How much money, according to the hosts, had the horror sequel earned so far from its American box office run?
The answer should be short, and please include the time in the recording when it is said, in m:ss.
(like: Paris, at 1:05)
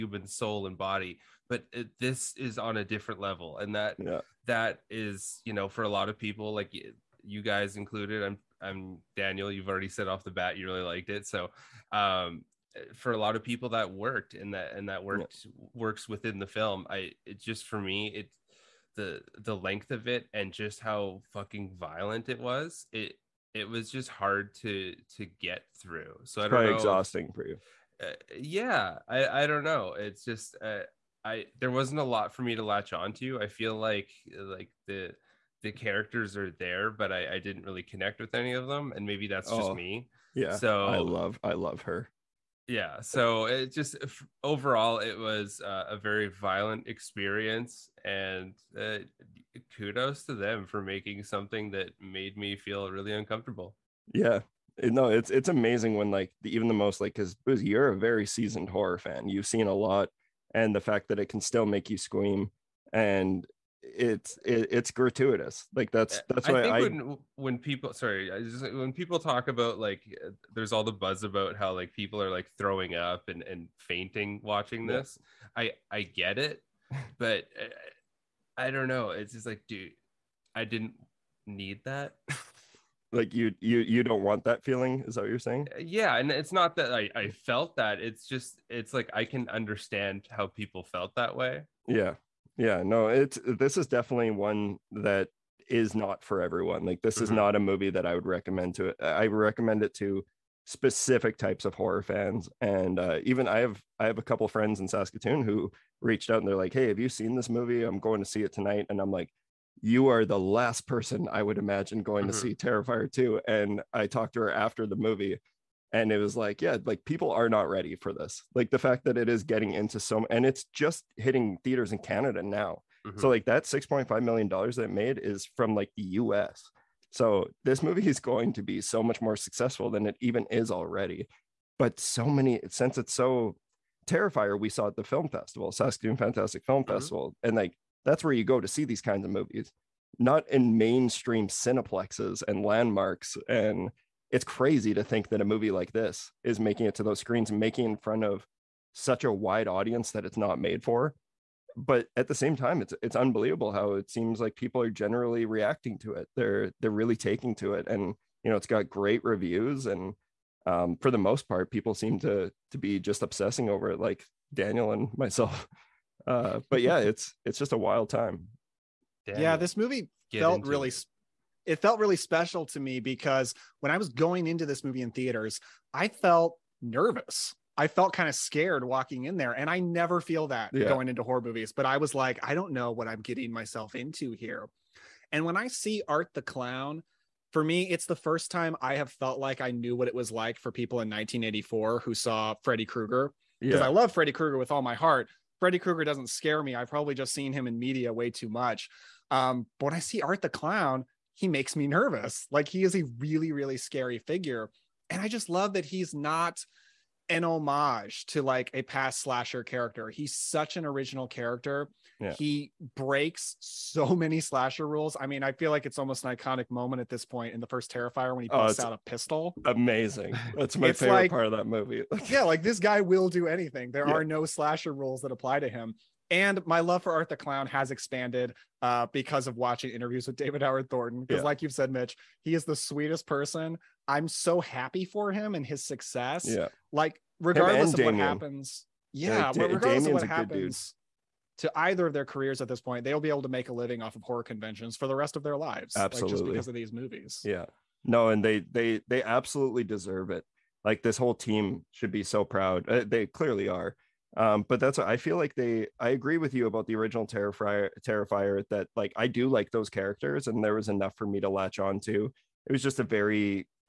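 6.5 million dollars, at 2:03.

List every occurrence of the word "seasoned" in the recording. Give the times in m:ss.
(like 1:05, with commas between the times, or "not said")
0:58.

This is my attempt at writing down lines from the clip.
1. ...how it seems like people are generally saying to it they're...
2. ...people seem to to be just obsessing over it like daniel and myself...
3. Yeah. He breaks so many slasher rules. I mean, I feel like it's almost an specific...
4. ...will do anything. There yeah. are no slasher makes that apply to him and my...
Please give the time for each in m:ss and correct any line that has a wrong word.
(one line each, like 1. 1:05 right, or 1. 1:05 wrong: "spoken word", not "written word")
1. 2:33 wrong: "reacting", not "saying"
2. 2:41 right
3. 3:32 wrong: "iconic", not "specific"
4. 3:43 wrong: "rules", not "makes".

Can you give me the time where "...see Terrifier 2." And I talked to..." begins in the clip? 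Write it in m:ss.
1:52.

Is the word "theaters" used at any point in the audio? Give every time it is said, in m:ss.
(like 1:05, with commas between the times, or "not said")
2:01, 2:55.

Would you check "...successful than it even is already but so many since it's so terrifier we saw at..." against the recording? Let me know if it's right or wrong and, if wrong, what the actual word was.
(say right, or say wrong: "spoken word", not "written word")
right.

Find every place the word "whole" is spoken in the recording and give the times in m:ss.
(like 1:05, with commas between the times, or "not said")
4:11.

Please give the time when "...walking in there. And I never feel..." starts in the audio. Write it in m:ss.
2:58.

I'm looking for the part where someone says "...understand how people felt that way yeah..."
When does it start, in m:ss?
1:29.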